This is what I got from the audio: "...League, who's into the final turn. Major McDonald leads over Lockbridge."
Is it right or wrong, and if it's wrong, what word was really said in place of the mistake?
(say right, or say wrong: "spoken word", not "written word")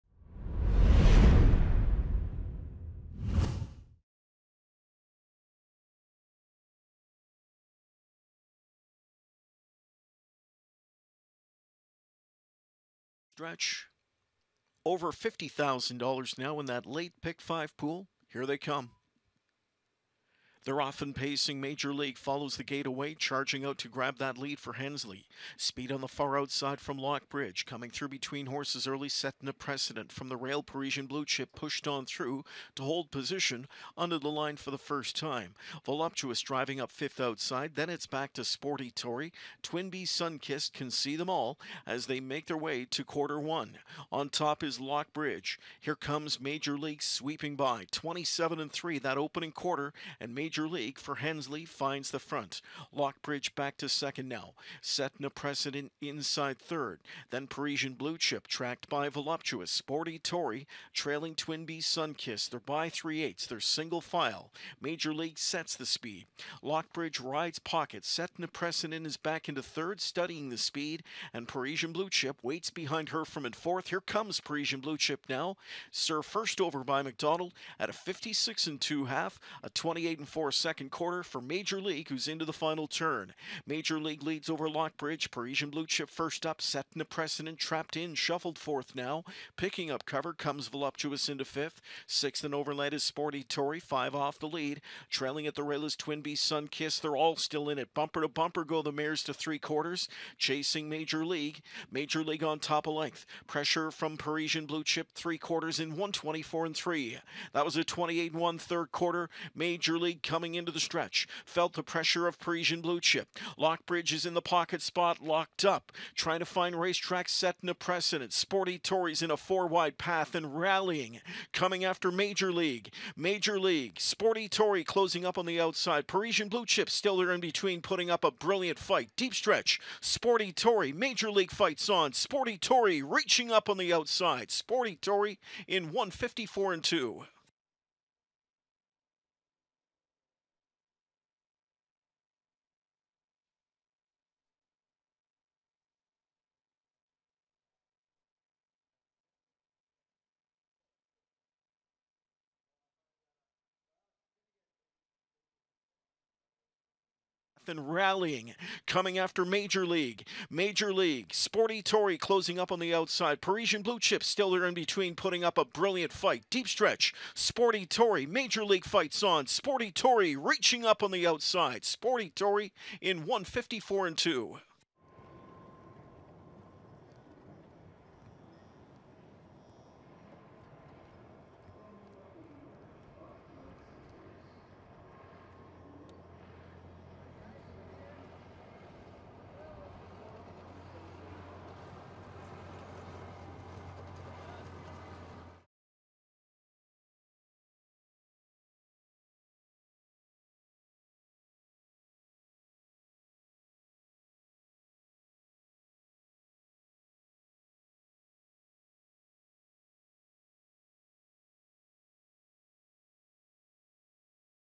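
wrong: "League", not "McDonald".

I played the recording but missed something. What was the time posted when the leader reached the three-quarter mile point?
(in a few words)
1:24.3.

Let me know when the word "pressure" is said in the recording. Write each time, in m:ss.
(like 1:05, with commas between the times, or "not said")
1:43, 1:51.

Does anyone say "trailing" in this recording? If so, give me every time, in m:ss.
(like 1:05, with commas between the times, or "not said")
1:00, 1:35.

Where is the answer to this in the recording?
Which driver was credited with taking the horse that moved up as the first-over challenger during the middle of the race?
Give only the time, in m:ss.
1:17.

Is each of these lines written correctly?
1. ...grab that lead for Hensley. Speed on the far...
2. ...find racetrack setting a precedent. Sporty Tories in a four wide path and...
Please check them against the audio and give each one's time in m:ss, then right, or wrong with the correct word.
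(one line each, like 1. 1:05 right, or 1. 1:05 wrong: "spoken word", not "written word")
1. 0:23 right
2. 1:56 right.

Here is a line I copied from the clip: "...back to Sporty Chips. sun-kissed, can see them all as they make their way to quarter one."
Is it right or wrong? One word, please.
wrong.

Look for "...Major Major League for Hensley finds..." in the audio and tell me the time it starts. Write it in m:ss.
0:50.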